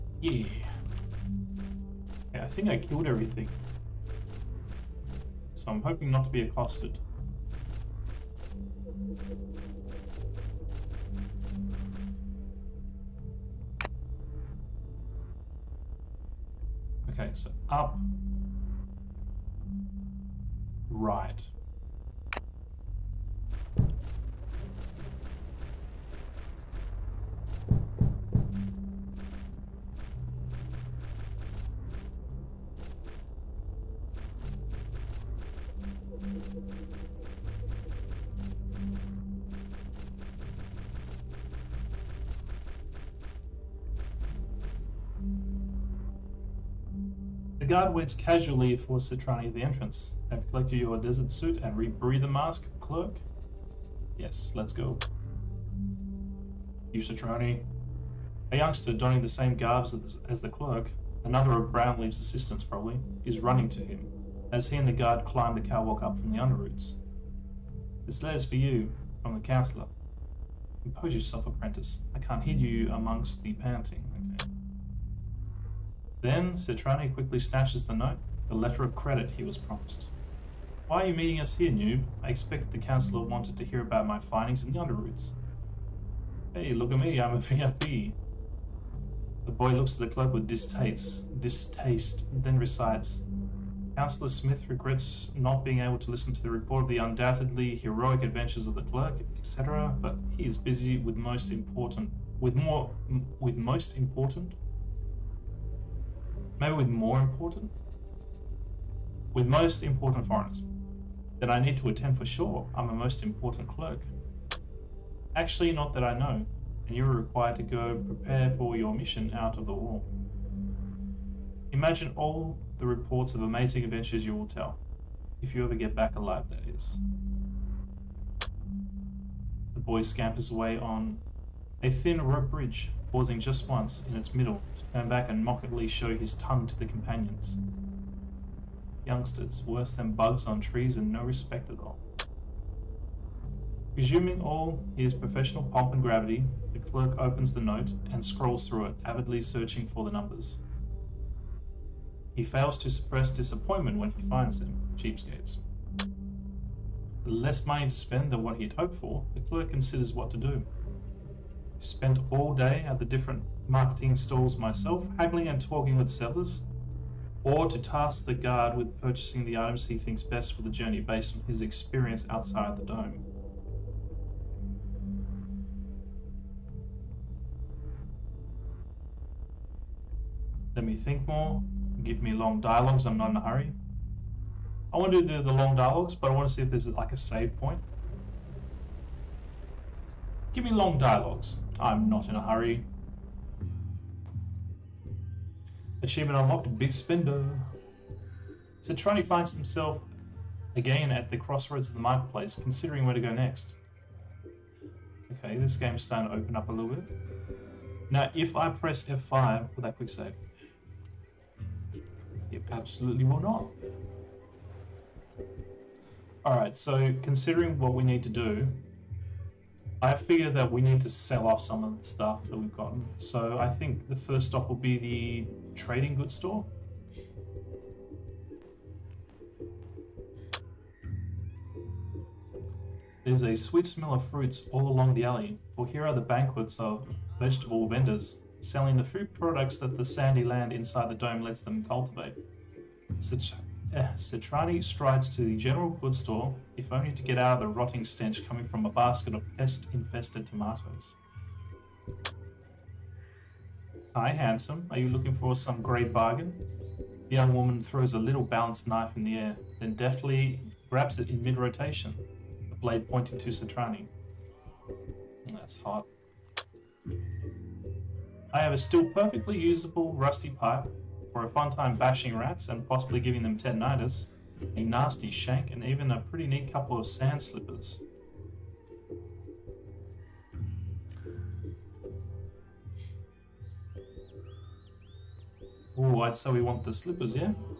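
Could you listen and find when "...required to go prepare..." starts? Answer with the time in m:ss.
1:57.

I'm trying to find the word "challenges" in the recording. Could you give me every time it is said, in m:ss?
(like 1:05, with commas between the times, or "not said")
not said.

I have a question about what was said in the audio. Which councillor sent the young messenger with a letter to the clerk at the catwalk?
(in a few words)
Councillor Smith.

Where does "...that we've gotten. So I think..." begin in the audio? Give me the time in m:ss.
3:42.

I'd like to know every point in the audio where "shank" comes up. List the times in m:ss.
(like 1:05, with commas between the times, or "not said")
4:35.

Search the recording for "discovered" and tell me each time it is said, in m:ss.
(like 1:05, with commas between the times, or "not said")
not said.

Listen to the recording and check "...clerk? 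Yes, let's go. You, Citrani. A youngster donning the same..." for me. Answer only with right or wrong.
right.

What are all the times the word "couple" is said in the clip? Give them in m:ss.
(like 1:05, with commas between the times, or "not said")
4:36.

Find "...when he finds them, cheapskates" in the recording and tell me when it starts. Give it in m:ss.
2:33.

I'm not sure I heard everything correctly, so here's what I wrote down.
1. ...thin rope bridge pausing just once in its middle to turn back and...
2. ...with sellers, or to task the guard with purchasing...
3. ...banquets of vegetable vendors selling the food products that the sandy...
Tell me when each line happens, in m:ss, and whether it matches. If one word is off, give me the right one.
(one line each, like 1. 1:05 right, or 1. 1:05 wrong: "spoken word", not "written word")
1. 2:11 right
2. 2:45 right
3. 3:56 right.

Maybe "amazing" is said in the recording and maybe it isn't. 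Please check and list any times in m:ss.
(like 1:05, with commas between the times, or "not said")
2:03.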